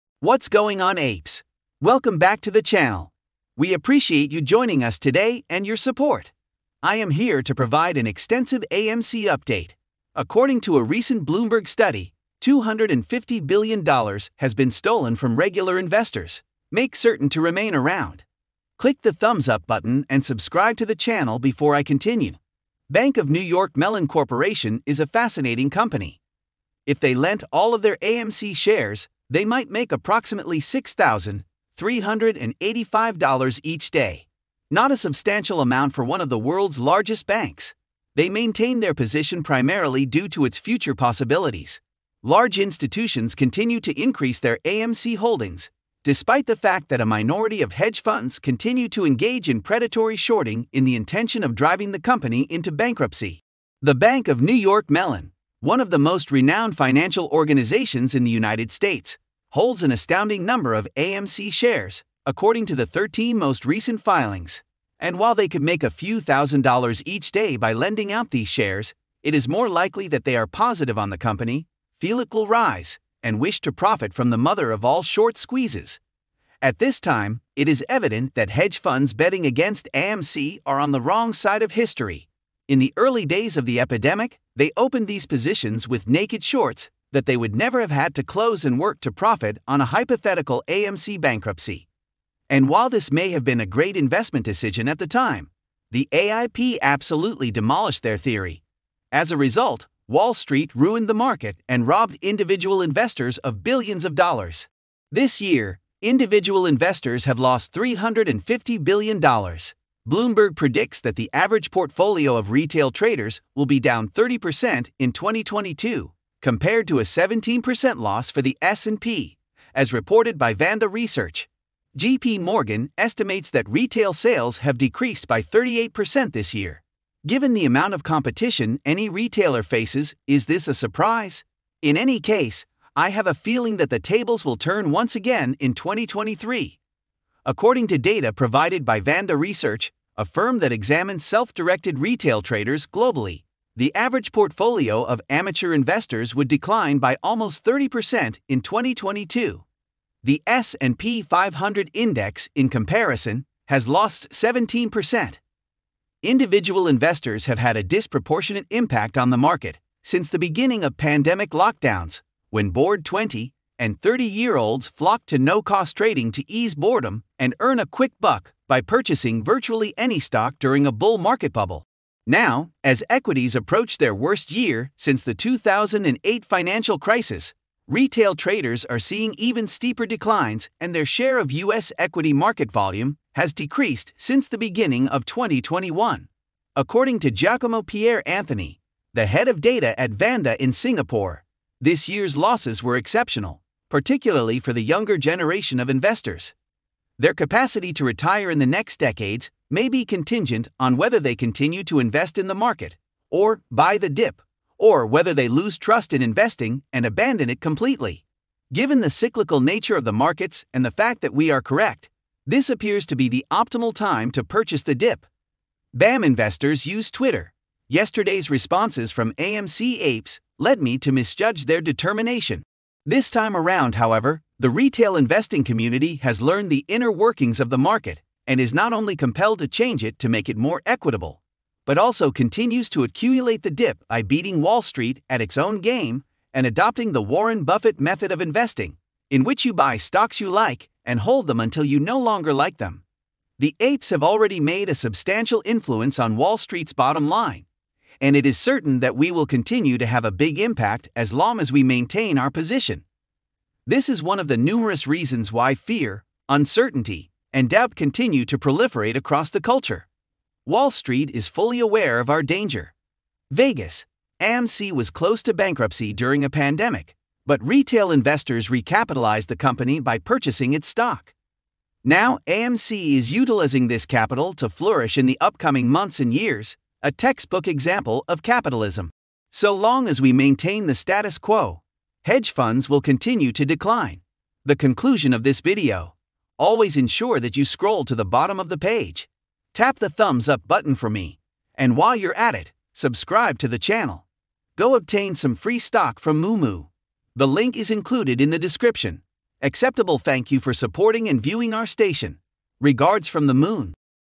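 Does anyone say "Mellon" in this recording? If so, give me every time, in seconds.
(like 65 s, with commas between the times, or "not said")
23 s, 54 s.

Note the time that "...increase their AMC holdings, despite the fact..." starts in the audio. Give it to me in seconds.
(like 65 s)
43 s.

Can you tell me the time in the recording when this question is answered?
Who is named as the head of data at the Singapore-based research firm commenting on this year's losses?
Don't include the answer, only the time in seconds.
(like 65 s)
187 s.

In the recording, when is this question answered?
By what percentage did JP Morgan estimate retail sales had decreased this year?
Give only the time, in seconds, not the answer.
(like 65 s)
125 s.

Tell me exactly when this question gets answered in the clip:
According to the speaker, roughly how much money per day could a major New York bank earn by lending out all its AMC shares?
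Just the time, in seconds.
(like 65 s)
30 s.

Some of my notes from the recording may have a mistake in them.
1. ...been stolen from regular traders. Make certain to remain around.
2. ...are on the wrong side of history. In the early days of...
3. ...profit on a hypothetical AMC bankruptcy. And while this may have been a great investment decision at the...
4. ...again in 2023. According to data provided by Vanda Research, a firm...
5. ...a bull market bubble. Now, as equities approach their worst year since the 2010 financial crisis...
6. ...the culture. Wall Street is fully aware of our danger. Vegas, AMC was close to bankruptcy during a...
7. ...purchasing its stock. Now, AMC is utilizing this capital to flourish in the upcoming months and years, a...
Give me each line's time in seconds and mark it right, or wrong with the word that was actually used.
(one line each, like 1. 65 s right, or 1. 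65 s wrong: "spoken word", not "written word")
1. 14 s wrong: "investors", not "traders"
2. 80 s right
3. 89 s right
4. 135 s right
5. 170 s wrong: "2008", not "2010"
6. 259 s right
7. 270 s right.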